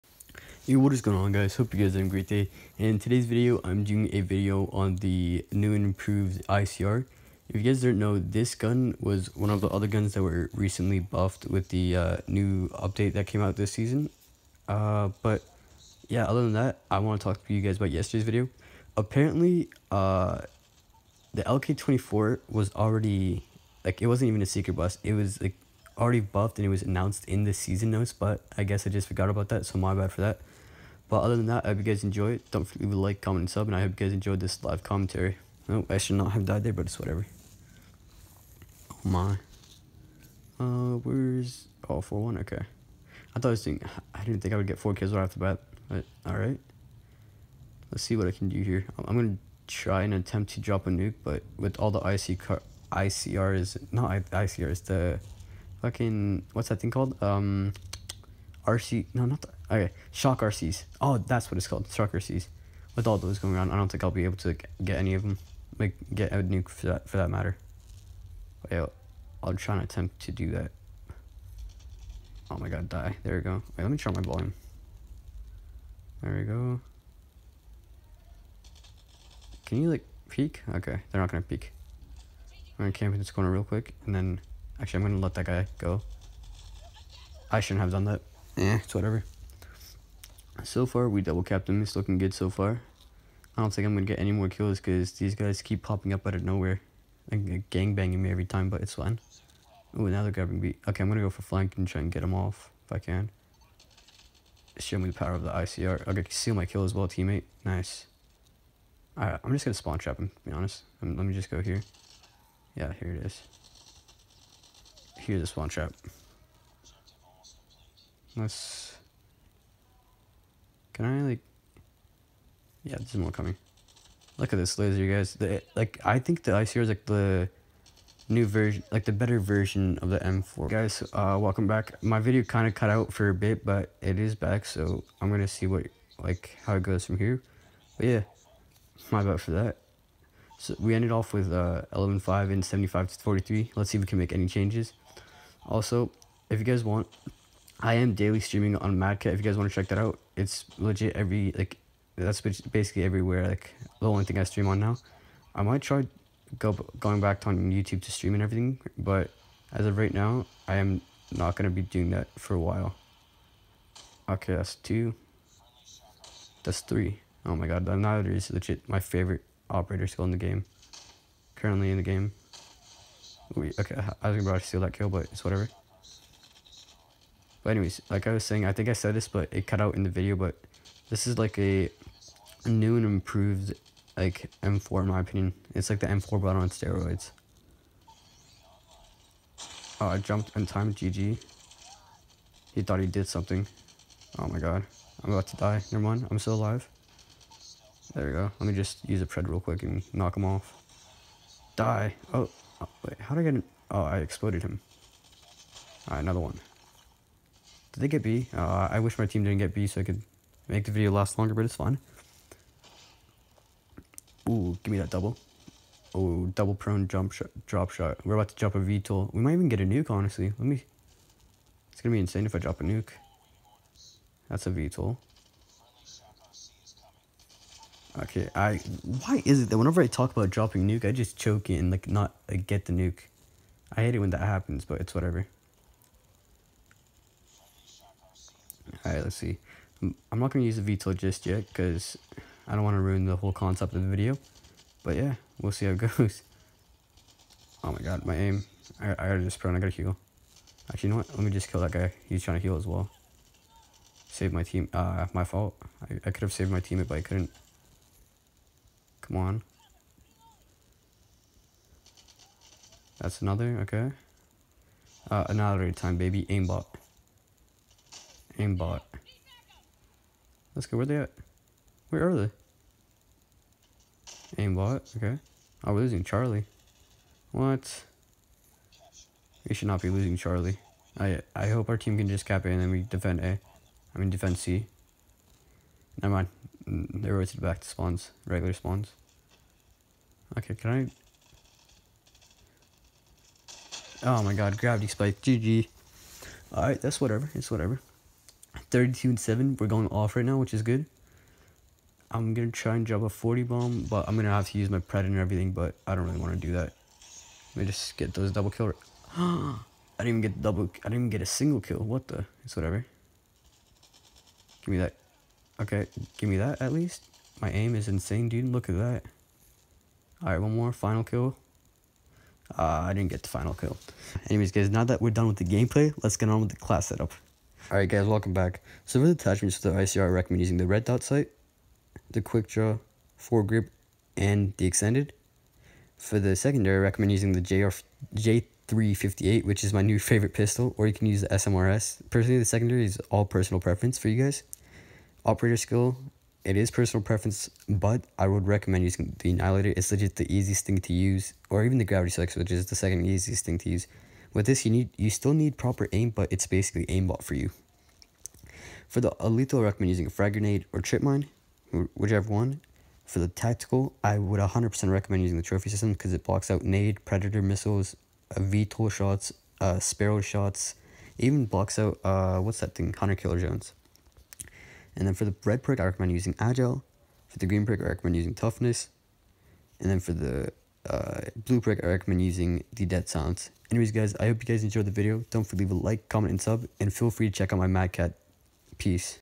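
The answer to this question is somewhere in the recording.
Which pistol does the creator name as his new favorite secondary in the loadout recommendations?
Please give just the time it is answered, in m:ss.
5:38.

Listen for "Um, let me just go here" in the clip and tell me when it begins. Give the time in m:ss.
1:51.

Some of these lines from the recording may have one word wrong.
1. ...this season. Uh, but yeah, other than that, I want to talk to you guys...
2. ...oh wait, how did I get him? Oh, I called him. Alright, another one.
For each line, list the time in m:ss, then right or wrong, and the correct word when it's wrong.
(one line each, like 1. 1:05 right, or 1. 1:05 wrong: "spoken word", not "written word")
1. 0:13 right
2. 3:22 wrong: "exploded", not "called".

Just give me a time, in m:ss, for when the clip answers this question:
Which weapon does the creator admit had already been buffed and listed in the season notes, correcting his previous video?
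0:21.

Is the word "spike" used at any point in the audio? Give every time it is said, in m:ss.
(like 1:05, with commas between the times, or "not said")
4:55, 5:52.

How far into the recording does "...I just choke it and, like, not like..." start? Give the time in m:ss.
3:51.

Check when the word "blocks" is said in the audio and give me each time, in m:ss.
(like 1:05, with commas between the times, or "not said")
6:06, 6:11.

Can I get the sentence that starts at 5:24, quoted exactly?
Anyways, guys, now that we're done with the gameplay, let's get on with the class setup.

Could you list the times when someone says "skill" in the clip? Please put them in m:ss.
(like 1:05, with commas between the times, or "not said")
2:50, 5:45.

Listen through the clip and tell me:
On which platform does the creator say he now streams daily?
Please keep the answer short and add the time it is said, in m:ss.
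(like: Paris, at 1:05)
Madcat, at 2:28.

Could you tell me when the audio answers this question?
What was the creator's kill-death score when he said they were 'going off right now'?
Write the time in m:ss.
4:58.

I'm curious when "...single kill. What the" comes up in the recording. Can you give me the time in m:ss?
5:11.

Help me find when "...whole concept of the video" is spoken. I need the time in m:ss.
4:03.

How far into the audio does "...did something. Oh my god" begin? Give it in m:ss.
3:13.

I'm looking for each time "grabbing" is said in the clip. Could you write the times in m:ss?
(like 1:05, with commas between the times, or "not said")
1:40.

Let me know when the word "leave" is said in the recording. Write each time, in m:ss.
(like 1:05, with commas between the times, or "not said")
0:32, 6:25.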